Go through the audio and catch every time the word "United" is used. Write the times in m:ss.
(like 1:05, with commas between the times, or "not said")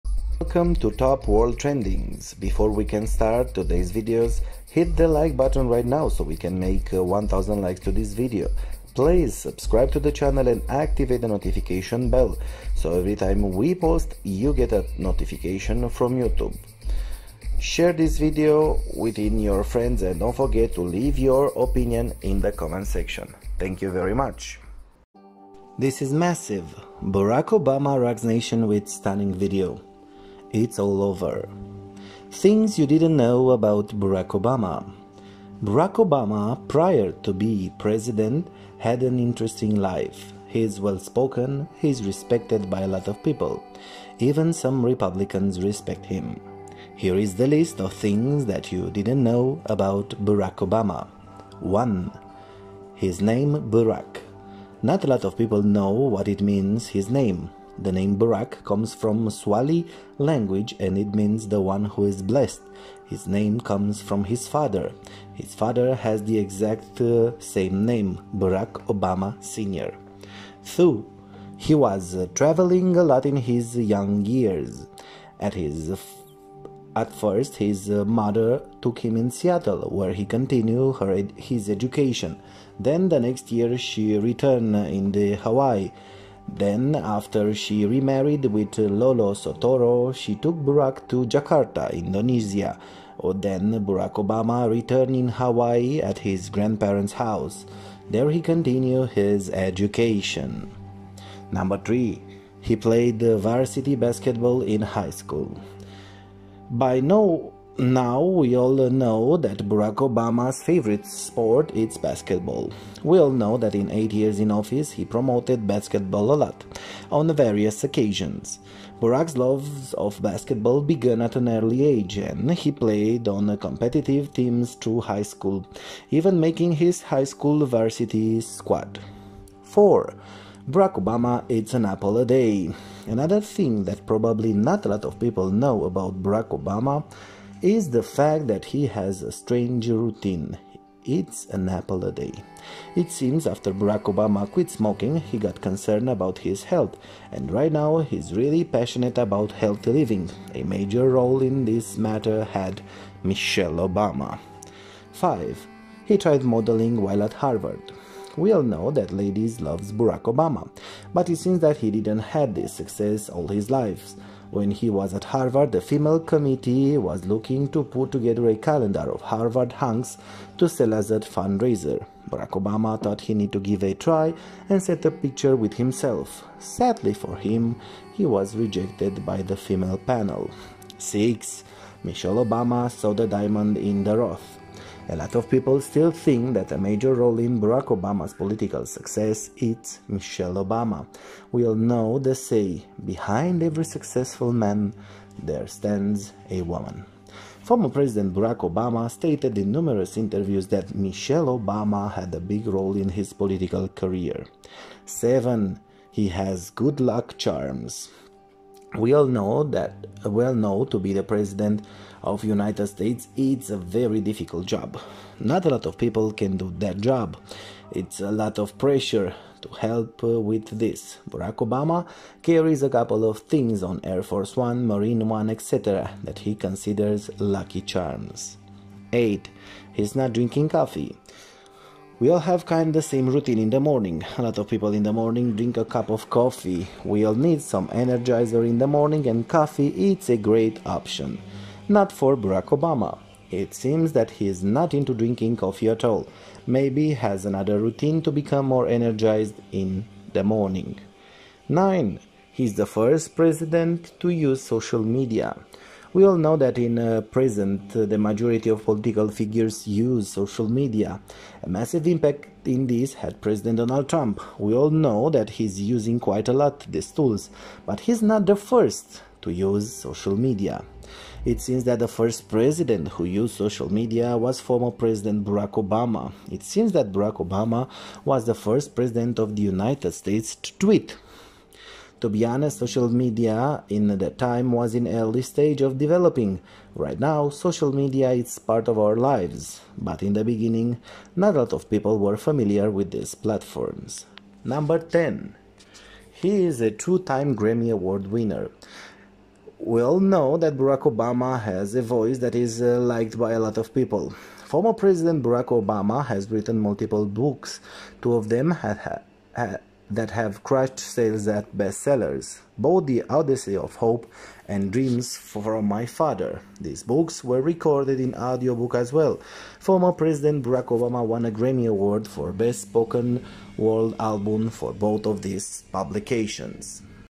3:32, 4:39.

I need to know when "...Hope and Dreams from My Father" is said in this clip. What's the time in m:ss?
5:13.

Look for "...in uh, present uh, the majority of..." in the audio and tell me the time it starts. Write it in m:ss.
4:16.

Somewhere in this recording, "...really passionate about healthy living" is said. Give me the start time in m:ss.
2:28.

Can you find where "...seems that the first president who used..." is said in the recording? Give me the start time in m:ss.
4:31.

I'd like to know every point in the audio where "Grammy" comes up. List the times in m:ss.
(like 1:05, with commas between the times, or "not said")
4:57, 5:21.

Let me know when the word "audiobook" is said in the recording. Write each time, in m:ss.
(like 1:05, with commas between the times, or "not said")
5:18.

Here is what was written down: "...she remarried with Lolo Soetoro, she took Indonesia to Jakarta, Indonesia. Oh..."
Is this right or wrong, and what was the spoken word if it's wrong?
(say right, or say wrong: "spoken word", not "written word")
wrong: "Barack", not "Indonesia".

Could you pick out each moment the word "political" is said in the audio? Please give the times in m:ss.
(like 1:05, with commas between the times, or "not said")
3:08, 3:23, 4:18.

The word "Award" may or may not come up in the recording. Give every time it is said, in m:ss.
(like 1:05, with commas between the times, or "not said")
4:57, 5:21.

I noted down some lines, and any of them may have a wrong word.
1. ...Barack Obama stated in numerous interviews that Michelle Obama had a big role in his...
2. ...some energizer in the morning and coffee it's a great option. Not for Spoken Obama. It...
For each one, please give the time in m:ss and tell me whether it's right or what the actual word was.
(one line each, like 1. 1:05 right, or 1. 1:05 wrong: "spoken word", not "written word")
1. 3:18 right
2. 3:57 wrong: "Barack", not "Spoken".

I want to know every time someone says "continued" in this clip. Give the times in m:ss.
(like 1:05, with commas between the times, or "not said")
1:20, 1:38.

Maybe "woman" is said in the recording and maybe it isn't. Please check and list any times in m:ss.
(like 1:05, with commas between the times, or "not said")
3:16.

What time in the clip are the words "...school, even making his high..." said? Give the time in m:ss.
2:05.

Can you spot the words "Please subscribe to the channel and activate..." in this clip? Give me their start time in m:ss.
0:08.